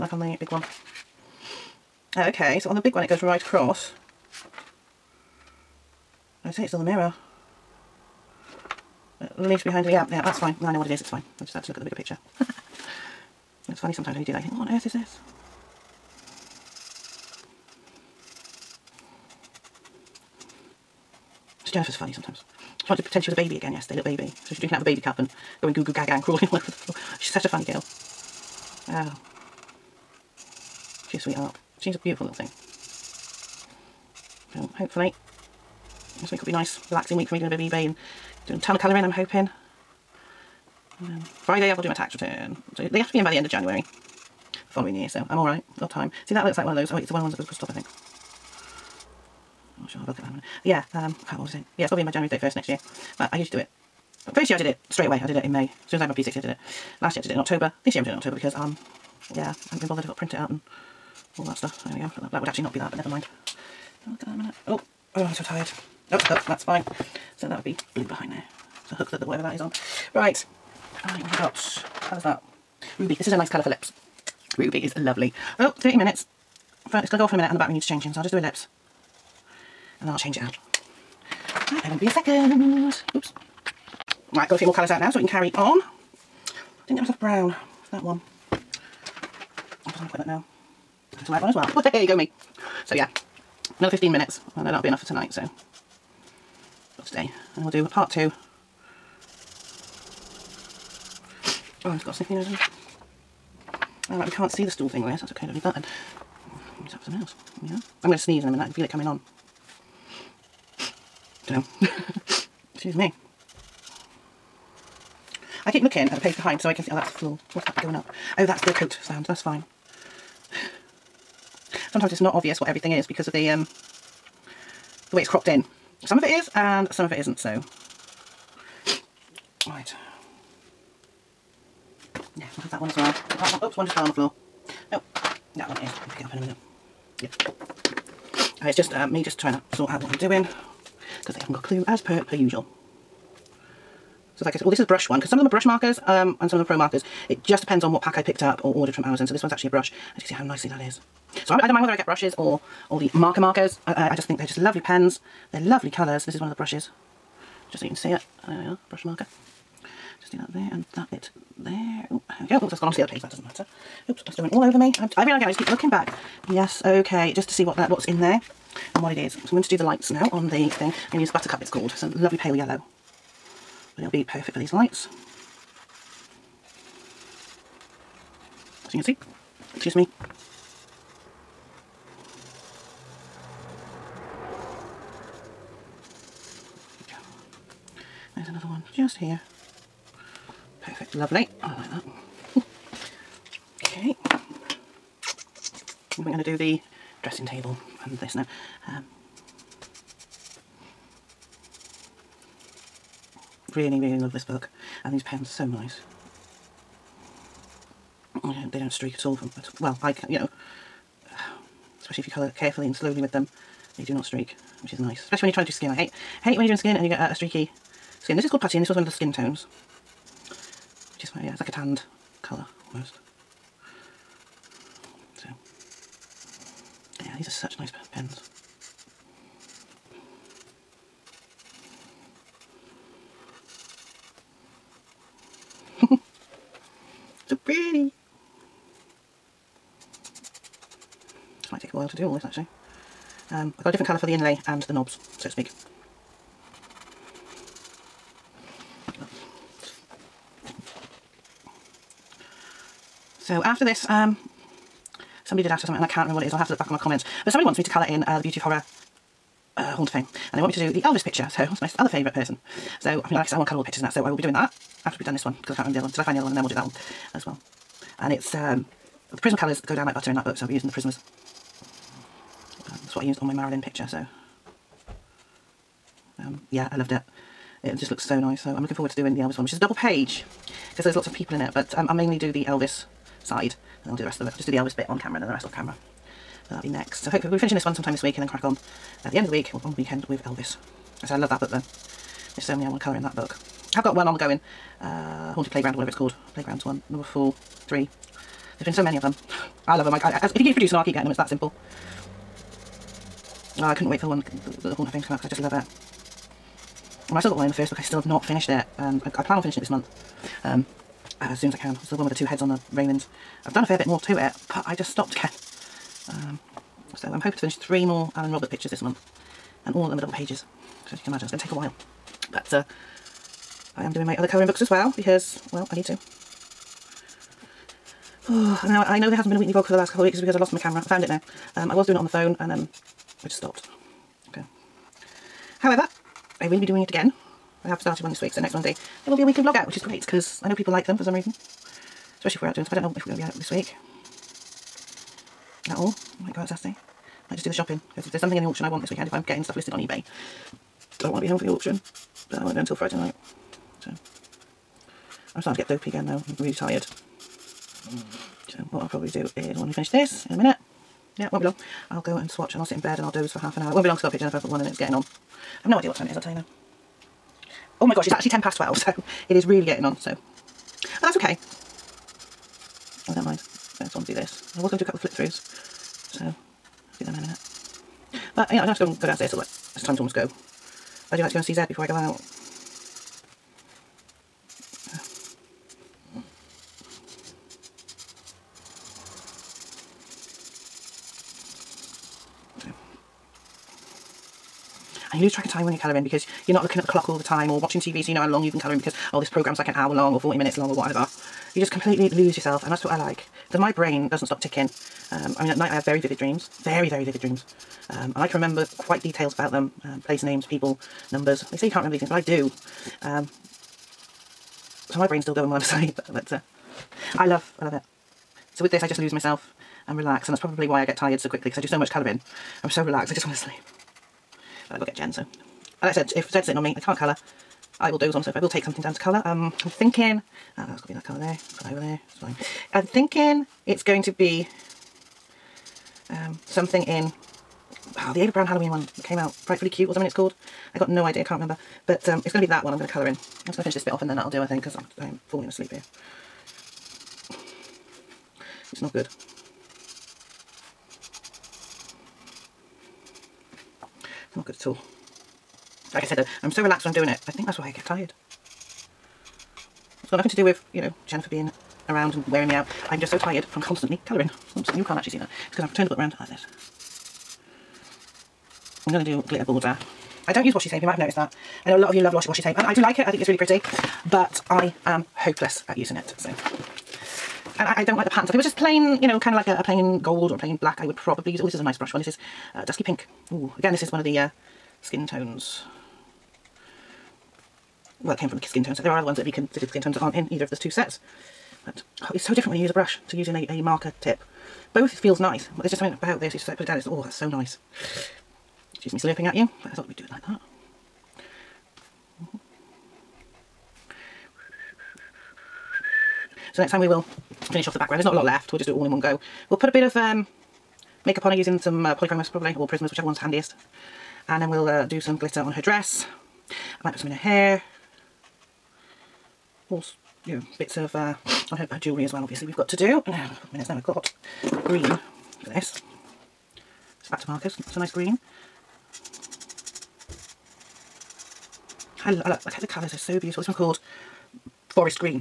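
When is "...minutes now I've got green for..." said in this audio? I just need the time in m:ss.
8:43.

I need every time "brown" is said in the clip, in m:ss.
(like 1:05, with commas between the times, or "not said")
1:27, 7:18.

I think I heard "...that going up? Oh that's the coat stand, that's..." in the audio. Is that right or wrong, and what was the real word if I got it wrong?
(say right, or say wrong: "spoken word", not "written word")
right.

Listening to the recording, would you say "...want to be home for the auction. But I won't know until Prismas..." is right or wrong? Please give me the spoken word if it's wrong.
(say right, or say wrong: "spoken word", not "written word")
wrong: "Friday", not "Prismas".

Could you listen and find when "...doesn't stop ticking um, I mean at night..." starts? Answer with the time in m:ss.
6:44.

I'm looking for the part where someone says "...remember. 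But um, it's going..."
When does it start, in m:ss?
7:21.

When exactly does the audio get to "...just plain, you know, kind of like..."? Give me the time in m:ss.
7:58.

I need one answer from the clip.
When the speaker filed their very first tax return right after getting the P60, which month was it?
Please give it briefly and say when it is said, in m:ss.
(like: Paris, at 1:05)
May, at 0:55.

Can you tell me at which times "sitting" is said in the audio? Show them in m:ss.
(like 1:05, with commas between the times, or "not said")
7:06.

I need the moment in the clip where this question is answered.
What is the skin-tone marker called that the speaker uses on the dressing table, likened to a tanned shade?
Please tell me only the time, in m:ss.
3:38.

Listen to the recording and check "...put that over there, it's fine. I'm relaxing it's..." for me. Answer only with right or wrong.
wrong.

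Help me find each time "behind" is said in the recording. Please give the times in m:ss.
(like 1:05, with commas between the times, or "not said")
0:09, 1:08, 1:56.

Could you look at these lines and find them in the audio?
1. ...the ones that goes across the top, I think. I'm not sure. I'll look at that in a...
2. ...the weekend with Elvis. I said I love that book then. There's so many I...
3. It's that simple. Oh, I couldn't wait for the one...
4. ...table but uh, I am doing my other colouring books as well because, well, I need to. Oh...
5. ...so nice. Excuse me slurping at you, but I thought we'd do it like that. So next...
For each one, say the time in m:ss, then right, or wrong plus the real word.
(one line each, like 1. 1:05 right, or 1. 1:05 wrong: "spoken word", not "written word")
1. 0:47 right
2. 4:49 right
3. 5:01 right
4. 5:21 wrong: "while", not "table"
5. 8:17 right.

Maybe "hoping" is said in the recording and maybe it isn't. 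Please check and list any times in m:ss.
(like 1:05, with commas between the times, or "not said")
0:39, 5:17.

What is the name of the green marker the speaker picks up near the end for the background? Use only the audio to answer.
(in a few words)
Forest.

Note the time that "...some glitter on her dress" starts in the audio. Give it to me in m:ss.
8:35.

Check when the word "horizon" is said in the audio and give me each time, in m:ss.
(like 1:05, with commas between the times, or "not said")
not said.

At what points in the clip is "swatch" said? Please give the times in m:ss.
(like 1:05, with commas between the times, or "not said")
6:02.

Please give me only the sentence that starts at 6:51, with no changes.
They say you can't remember these things, but I do.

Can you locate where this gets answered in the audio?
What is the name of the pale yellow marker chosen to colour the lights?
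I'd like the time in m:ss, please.
2:51.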